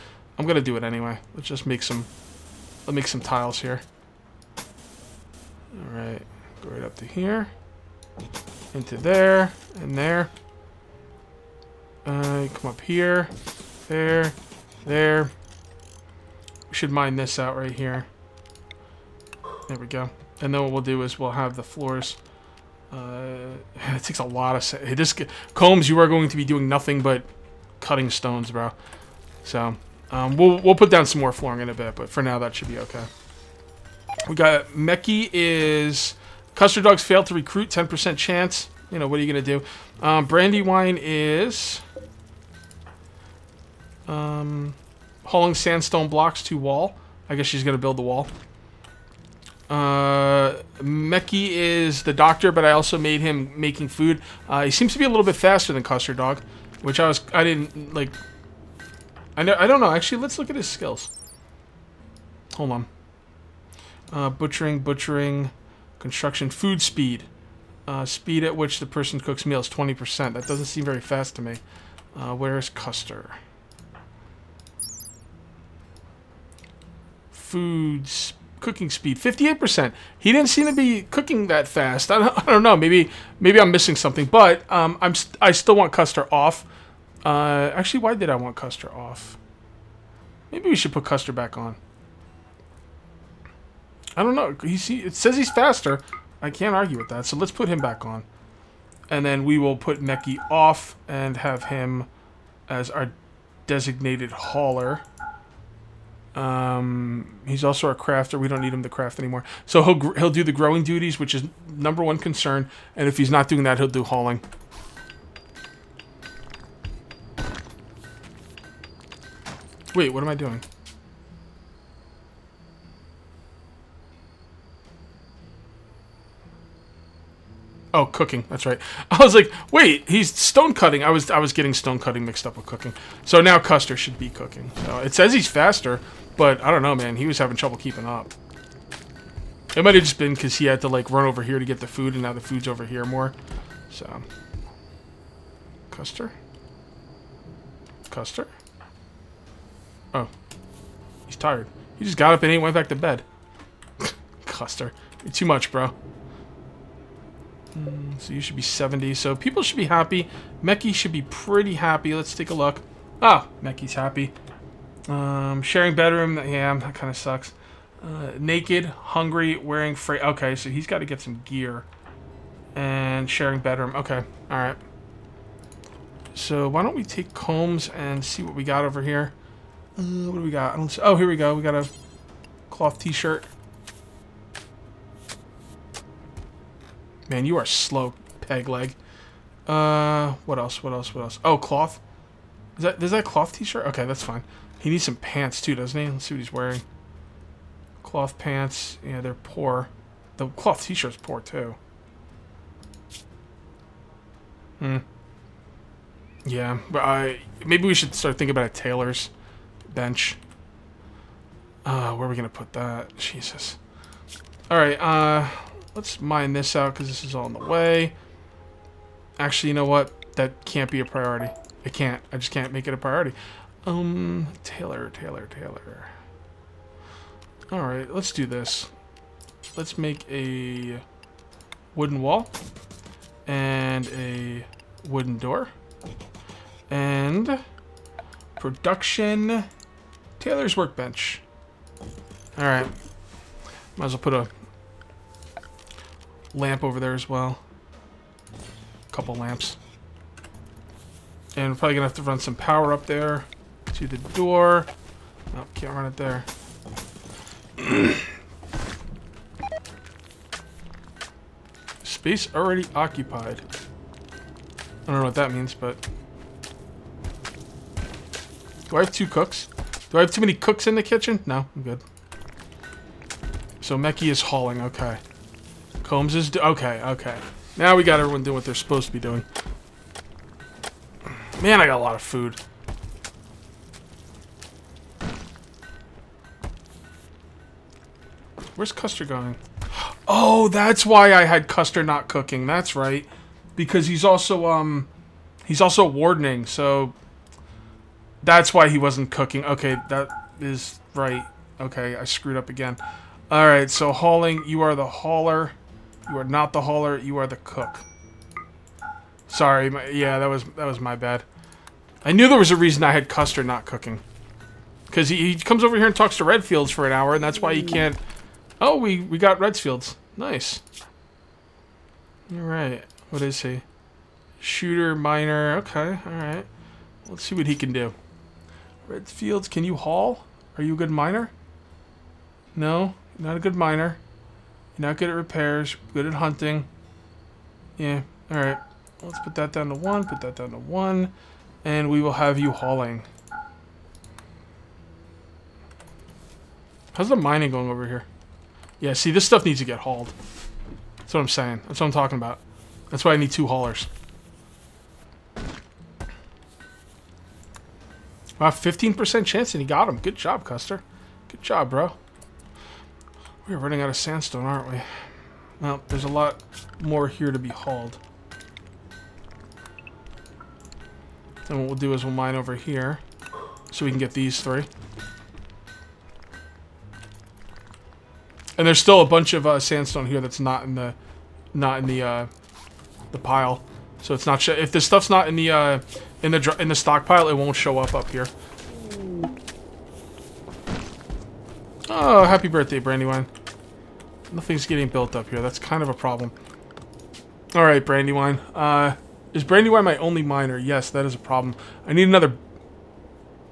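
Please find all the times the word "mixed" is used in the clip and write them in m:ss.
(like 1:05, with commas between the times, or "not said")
2:12.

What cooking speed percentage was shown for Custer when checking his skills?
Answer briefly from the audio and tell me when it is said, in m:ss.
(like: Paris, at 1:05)
58%, at 1:19.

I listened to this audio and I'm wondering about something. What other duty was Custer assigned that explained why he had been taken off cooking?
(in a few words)
Wardening.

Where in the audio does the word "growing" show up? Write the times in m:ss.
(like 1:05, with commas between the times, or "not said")
1:50.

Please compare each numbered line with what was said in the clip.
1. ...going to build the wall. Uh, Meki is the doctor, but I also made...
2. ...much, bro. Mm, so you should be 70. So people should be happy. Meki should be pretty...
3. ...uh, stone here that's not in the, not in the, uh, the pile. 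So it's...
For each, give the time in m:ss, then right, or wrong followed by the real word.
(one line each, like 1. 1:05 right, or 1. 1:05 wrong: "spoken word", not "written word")
1. 0:47 right
2. 2:35 right
3. 6:19 wrong: "sandstone", not "stone".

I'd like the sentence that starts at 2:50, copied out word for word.
Okay, so he's got to get some gear.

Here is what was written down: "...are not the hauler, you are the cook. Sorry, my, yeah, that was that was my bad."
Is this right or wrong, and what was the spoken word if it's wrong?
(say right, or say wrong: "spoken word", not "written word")
right.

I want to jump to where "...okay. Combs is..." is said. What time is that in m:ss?
4:34.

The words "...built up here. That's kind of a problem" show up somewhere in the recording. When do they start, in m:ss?
6:35.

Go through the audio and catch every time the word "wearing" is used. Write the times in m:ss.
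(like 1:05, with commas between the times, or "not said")
2:49, 3:16.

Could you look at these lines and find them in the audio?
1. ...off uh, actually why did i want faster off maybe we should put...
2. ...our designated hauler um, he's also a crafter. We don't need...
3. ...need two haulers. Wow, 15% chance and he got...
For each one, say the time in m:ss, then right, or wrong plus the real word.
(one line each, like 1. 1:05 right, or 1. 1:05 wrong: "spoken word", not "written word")
1. 1:26 wrong: "custer", not "faster"
2. 1:42 right
3. 5:53 right.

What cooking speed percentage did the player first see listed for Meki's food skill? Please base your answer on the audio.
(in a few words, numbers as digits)
20%.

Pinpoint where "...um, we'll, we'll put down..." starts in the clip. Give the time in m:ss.
0:30.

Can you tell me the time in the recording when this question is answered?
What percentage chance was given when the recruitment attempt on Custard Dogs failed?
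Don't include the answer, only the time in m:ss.
0:37.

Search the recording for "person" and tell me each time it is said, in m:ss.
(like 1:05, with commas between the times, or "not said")
1:08.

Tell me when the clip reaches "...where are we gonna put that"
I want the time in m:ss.
3:32.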